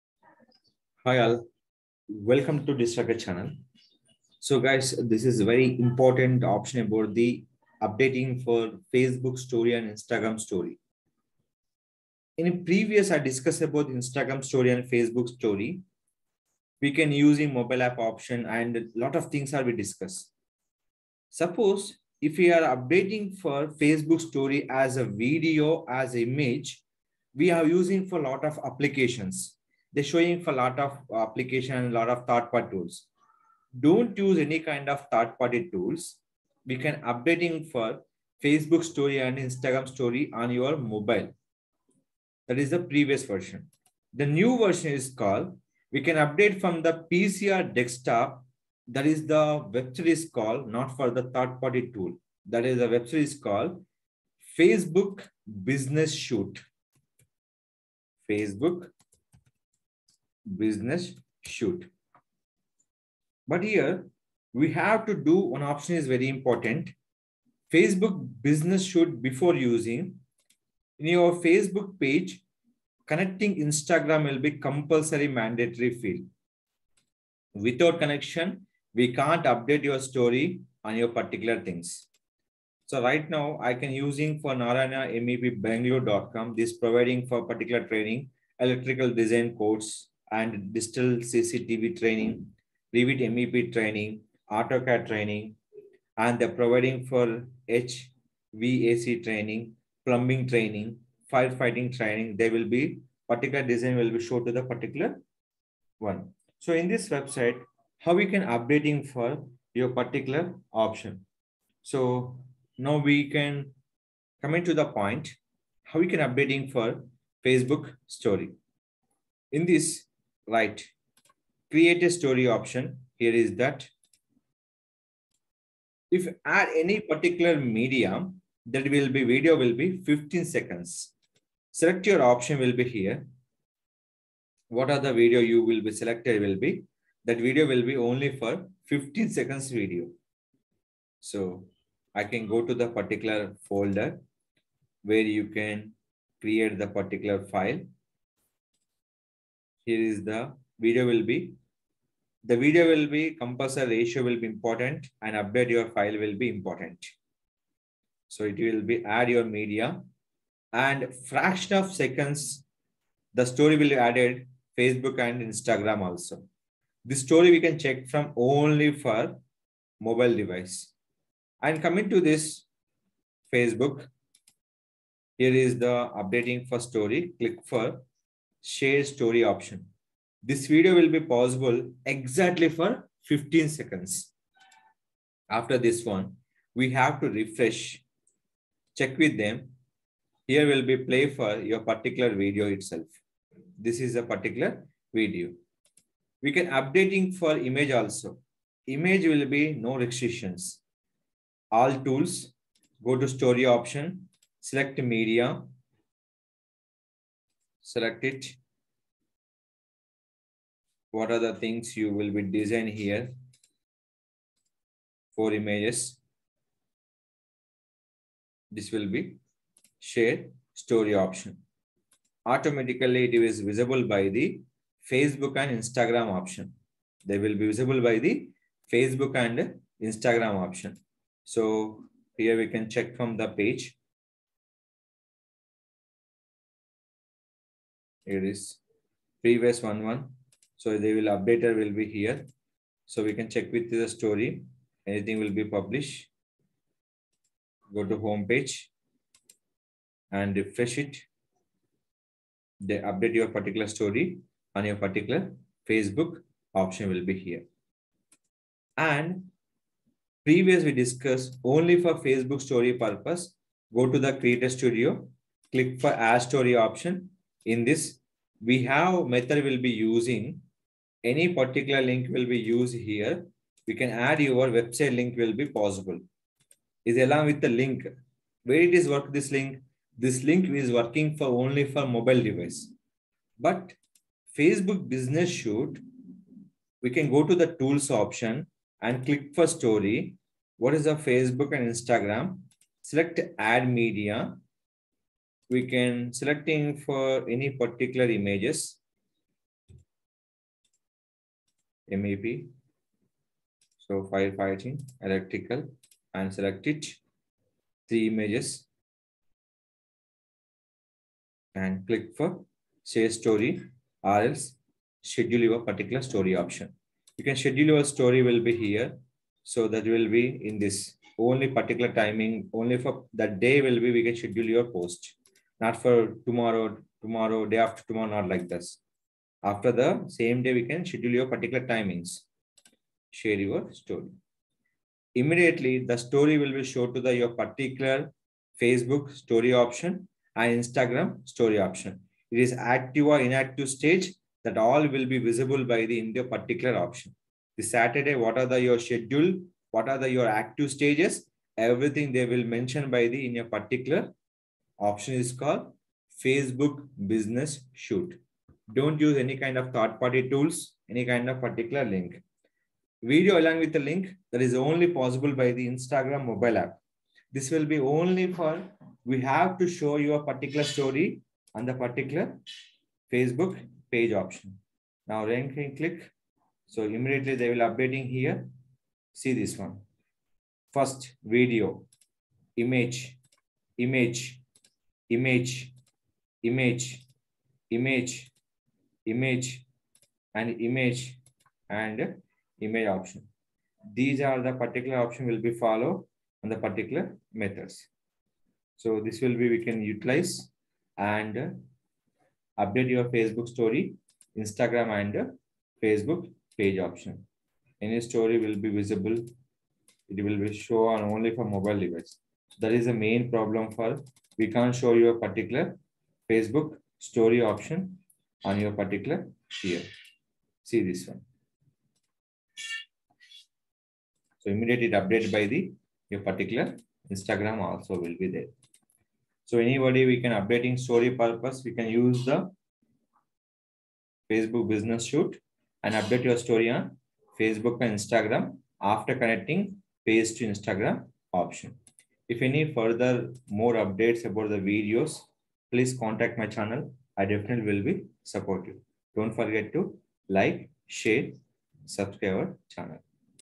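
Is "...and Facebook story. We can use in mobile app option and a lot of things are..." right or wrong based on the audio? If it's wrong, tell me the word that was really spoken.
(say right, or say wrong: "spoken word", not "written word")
right.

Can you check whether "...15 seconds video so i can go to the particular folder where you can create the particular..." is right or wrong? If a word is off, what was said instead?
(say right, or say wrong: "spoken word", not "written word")
right.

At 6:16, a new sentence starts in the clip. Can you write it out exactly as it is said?
So immediately they will updating here.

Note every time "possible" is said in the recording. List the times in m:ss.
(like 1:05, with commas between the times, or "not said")
3:01, 4:35, 6:05.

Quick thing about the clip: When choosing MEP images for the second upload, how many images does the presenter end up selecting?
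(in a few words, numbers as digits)
3.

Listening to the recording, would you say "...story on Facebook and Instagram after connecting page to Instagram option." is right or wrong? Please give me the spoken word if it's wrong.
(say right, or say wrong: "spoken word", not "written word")
right.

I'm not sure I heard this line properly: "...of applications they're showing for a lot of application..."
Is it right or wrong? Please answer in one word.
right.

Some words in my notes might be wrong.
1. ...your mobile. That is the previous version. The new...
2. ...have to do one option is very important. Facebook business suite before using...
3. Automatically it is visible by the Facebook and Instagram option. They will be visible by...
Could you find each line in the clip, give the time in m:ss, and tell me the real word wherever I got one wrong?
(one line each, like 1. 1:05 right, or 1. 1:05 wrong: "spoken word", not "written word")
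1. 0:40 right
2. 1:04 right
3. 3:42 right.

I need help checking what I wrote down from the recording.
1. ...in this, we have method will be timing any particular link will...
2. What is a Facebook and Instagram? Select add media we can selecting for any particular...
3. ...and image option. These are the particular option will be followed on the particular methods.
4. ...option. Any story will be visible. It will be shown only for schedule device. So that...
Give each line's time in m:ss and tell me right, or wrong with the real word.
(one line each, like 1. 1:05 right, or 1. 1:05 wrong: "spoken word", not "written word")
1. 4:27 wrong: "using", not "timing"
2. 4:50 right
3. 6:31 right
4. 6:46 wrong: "mobile", not "schedule".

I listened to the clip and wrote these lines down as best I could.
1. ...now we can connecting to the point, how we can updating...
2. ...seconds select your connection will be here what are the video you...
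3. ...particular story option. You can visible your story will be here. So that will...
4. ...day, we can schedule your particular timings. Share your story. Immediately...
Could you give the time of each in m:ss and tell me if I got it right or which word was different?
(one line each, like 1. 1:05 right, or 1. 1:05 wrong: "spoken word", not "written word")
1. 1:52 wrong: "coming", not "connecting"
2. 2:10 wrong: "option", not "connection"
3. 5:15 wrong: "schedule", not "visible"
4. 5:30 right.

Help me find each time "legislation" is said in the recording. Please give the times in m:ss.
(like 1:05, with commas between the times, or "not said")
not said.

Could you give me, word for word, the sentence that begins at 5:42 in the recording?
It is active or inactive stage that all will be visible by the in your particular option.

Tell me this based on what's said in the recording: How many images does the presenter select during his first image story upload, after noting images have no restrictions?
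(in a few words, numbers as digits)
4.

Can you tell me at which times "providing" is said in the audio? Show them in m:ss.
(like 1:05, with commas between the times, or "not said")
1:26, 1:36.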